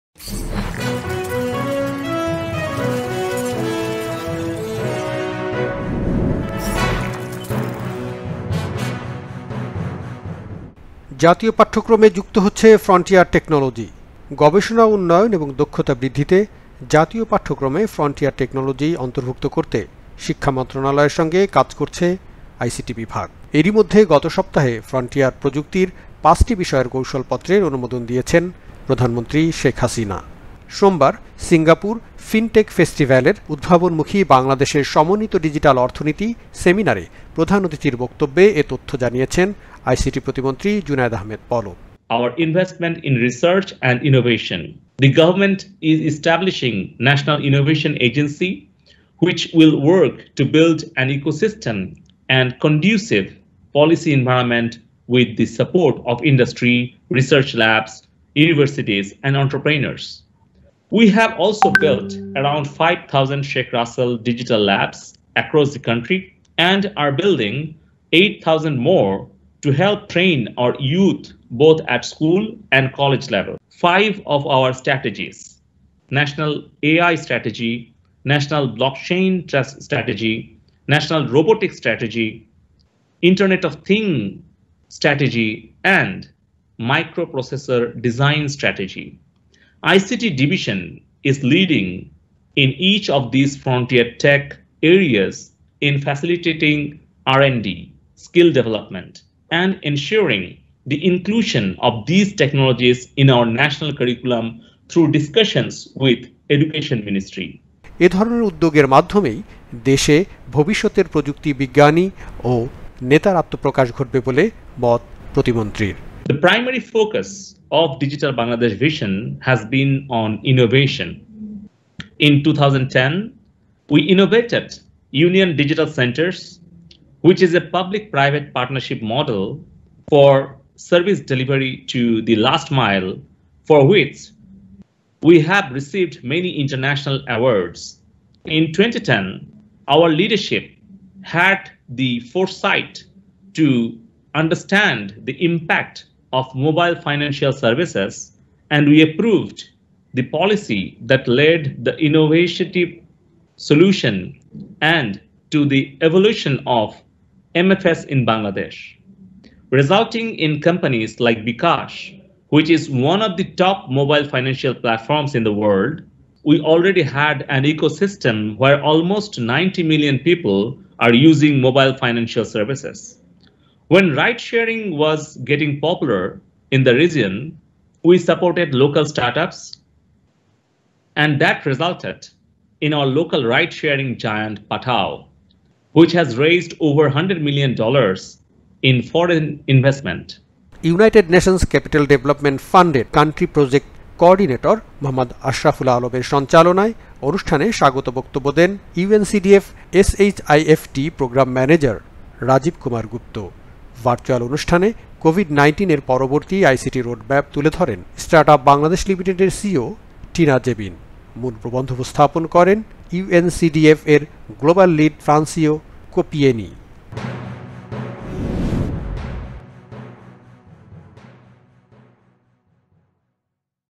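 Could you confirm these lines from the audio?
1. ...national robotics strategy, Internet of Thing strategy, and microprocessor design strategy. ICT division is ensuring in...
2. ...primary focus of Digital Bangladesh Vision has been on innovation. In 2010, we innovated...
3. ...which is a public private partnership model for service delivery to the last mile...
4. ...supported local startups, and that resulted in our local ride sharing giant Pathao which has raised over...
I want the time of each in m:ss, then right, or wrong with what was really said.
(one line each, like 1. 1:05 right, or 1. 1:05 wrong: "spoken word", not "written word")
1. 1:20 wrong: "leading", not "ensuring"
2. 1:56 right
3. 2:07 right
4. 2:58 right.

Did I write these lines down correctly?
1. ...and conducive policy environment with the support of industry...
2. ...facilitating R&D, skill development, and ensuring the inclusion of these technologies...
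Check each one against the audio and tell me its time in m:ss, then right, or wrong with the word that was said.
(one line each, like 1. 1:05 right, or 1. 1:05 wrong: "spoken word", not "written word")
1. 0:52 right
2. 1:36 right.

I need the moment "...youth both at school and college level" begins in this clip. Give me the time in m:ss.
1:10.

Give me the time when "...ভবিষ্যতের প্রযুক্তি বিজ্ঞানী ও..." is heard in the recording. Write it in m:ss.
1:50.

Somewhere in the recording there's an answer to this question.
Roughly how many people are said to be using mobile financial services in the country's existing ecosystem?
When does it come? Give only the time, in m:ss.
2:49.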